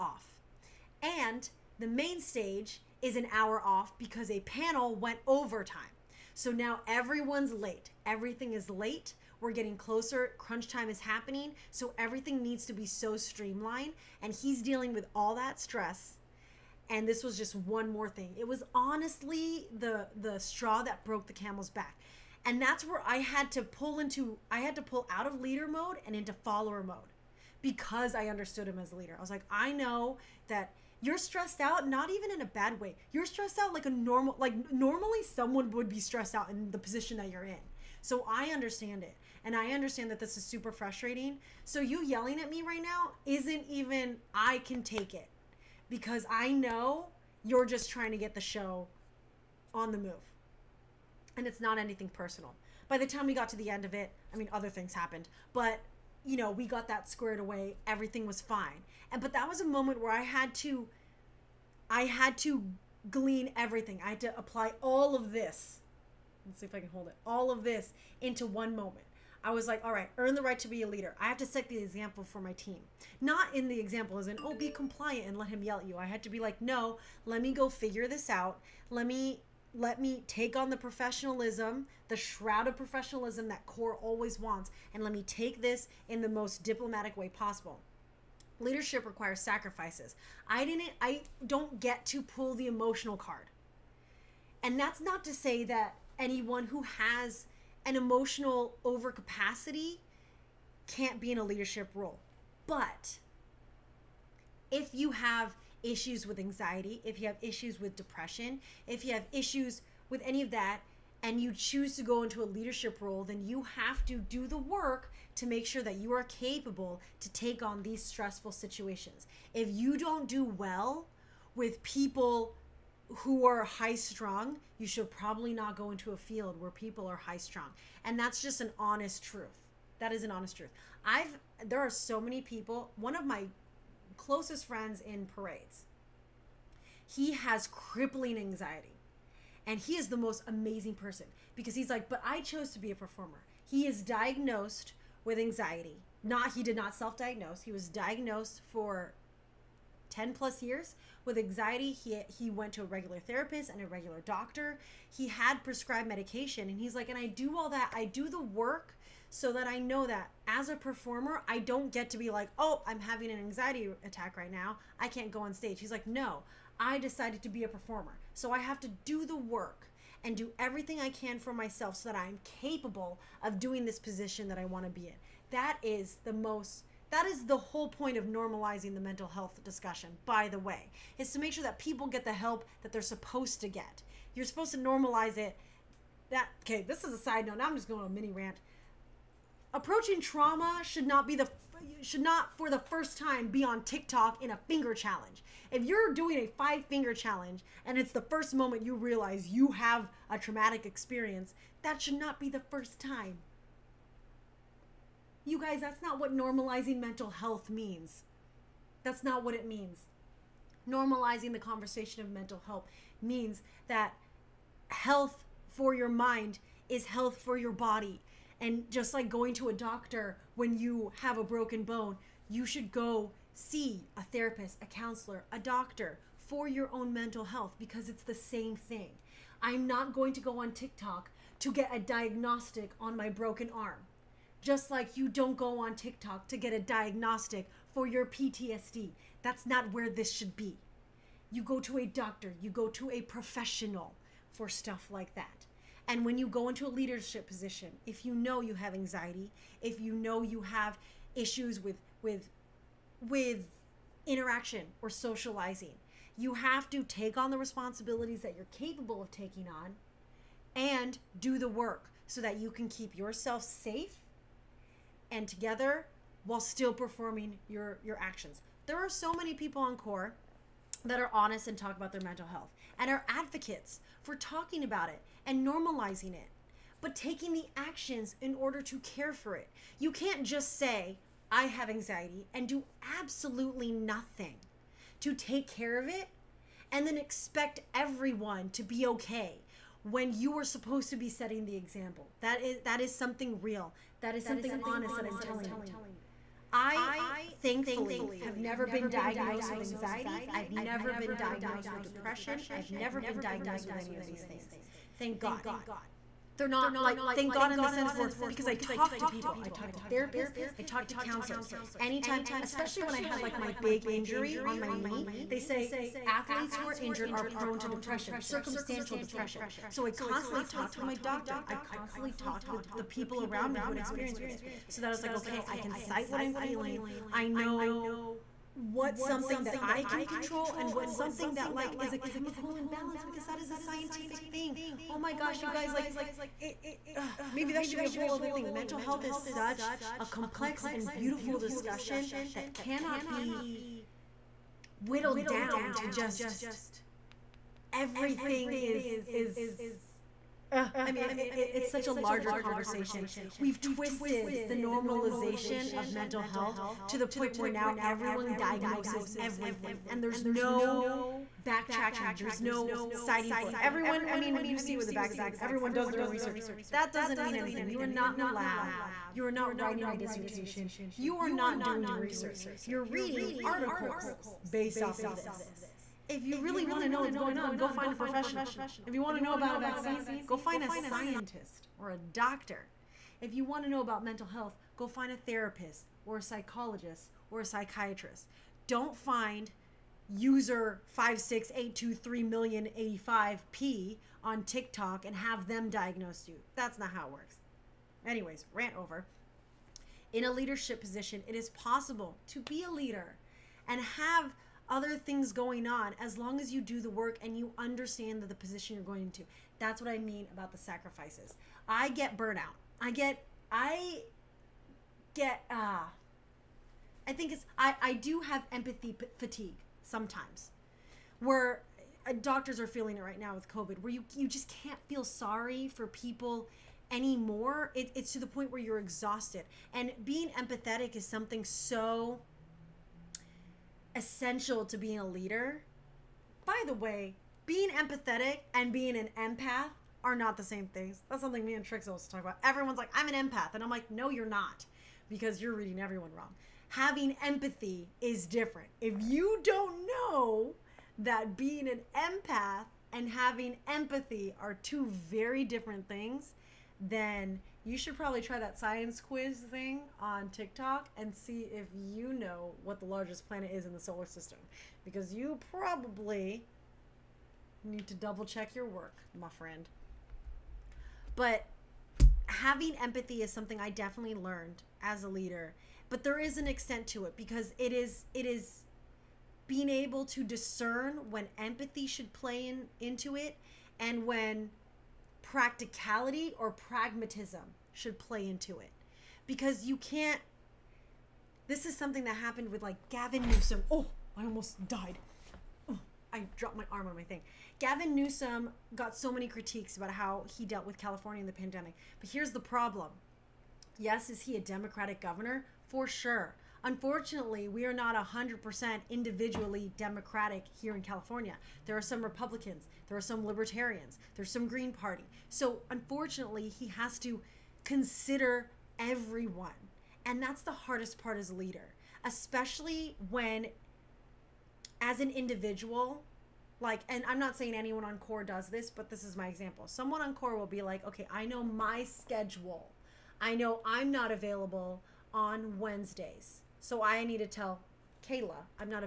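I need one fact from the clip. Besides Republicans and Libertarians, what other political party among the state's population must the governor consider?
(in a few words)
Green Party.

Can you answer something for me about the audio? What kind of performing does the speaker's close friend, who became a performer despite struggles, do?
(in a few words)
parades.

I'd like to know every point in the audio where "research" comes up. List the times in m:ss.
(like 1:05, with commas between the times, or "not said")
6:06, 6:12.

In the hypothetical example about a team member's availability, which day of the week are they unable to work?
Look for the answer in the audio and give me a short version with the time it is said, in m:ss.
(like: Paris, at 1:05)
Wednesdays, at 8:55.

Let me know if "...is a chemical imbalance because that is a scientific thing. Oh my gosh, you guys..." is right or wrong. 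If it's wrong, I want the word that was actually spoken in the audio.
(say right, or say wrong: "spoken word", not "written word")
right.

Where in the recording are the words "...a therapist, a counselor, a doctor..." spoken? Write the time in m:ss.
3:44.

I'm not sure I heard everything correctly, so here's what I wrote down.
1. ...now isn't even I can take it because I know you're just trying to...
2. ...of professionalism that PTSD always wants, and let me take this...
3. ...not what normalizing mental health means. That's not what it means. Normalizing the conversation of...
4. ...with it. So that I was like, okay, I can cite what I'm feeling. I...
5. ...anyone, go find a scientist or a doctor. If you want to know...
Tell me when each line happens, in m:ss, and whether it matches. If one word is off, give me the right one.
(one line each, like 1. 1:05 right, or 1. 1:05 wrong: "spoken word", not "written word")
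1. 0:42 right
2. 1:22 wrong: "Corps", not "PTSD"
3. 3:26 right
4. 5:24 right
5. 6:19 wrong: "vaccine", not "anyone".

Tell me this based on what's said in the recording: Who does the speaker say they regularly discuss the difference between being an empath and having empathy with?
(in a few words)
Trix.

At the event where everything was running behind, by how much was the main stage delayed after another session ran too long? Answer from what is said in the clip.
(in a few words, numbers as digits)
an hour.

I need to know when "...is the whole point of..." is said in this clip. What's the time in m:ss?
2:57.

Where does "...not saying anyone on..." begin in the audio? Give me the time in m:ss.
8:47.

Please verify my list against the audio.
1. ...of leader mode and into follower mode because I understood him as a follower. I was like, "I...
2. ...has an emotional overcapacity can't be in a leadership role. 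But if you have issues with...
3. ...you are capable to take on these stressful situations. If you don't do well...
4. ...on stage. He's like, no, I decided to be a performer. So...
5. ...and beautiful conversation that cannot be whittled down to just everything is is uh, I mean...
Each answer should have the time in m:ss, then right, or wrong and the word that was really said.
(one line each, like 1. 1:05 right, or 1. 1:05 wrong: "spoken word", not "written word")
1. 0:25 wrong: "leader", not "follower"
2. 1:36 right
3. 1:55 right
4. 2:45 right
5. 5:40 wrong: "discussion", not "conversation".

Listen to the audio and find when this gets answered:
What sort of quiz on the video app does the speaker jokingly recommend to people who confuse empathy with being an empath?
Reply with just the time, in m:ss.
7:38.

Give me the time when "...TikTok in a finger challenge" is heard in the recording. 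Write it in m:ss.
3:13.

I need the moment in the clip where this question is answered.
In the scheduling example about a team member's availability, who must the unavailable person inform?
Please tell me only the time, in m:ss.
8:58.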